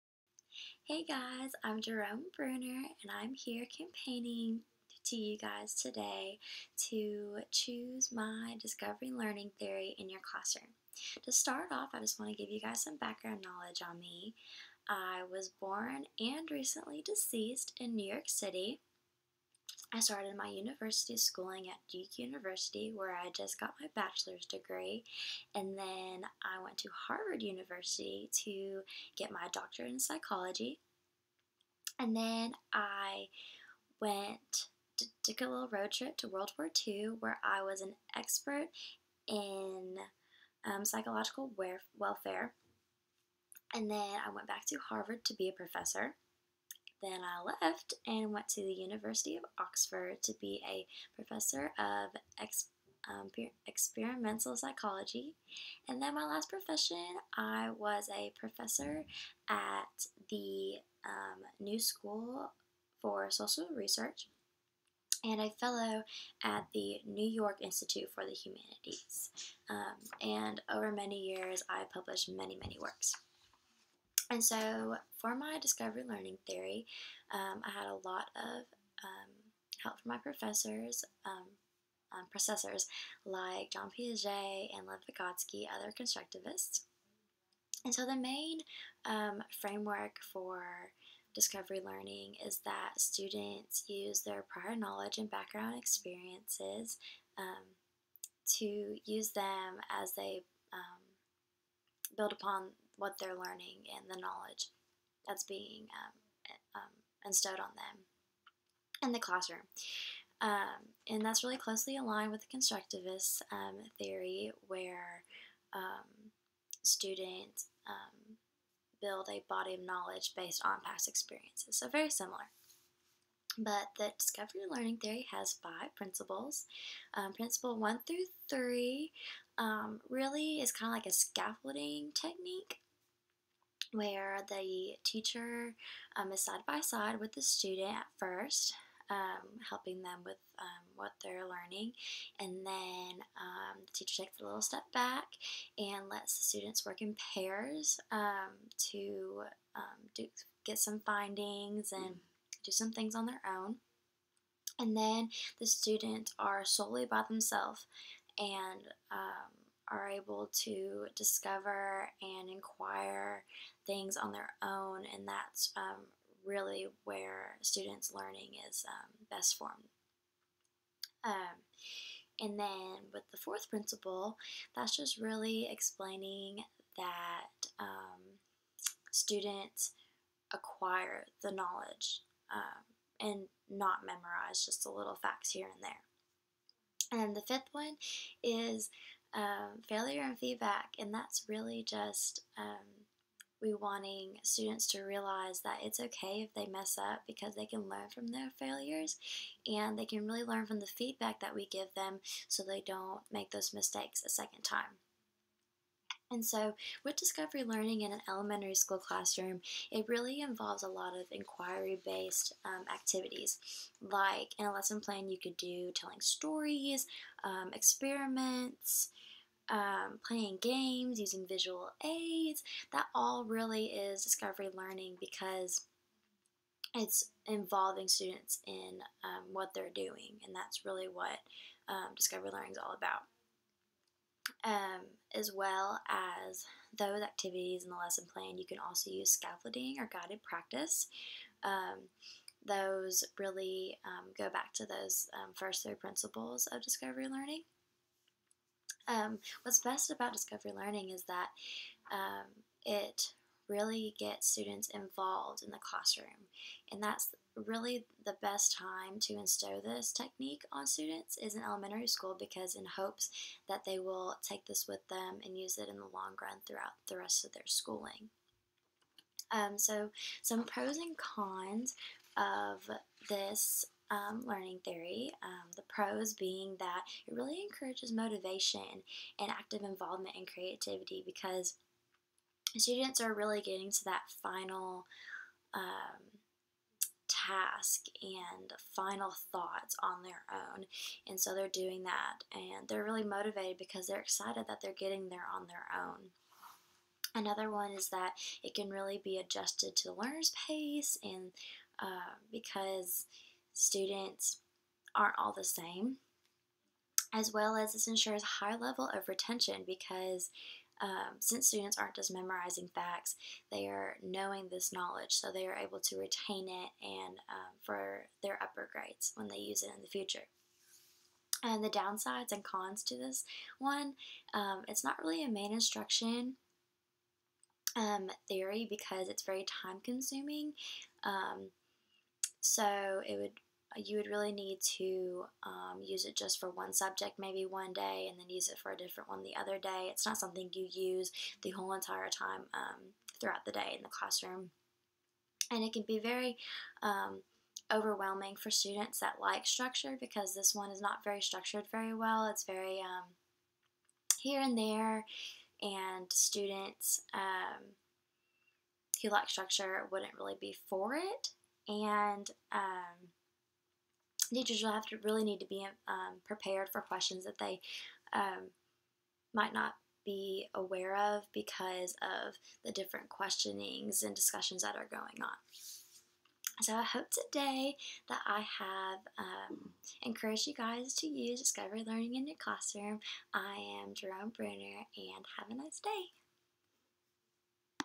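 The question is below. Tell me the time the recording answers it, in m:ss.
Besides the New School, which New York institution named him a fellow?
1:07.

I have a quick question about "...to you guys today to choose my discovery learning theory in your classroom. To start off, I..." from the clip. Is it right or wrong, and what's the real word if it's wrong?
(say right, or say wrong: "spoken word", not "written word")
right.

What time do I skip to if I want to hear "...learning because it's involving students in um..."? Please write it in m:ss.
3:44.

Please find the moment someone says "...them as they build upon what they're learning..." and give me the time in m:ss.
1:39.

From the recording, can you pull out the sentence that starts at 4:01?
Um, those really um, go back to those um, first three principles of discovery learning.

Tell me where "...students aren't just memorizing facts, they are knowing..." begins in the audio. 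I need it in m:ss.
5:11.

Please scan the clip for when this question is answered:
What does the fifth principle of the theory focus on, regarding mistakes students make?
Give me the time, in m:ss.
3:09.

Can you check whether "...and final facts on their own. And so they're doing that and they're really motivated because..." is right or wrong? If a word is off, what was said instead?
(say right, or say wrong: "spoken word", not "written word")
wrong: "thoughts", not "facts".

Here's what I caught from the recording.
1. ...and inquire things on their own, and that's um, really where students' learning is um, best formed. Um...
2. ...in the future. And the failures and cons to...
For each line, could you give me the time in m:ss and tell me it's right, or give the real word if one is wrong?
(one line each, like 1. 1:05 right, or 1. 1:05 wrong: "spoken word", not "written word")
1. 2:42 right
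2. 5:19 wrong: "downsides", not "failures".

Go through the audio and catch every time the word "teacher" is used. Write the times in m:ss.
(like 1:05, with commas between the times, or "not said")
2:15, 2:23, 6:04.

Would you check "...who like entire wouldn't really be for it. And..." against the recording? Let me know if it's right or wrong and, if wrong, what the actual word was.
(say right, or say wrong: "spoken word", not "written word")
wrong: "structure", not "entire".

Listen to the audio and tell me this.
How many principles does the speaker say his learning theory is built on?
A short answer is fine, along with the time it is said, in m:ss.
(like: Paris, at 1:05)
5, at 2:05.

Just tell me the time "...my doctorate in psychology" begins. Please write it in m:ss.
0:29.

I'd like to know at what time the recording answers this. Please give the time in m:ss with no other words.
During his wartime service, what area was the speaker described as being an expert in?
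0:40.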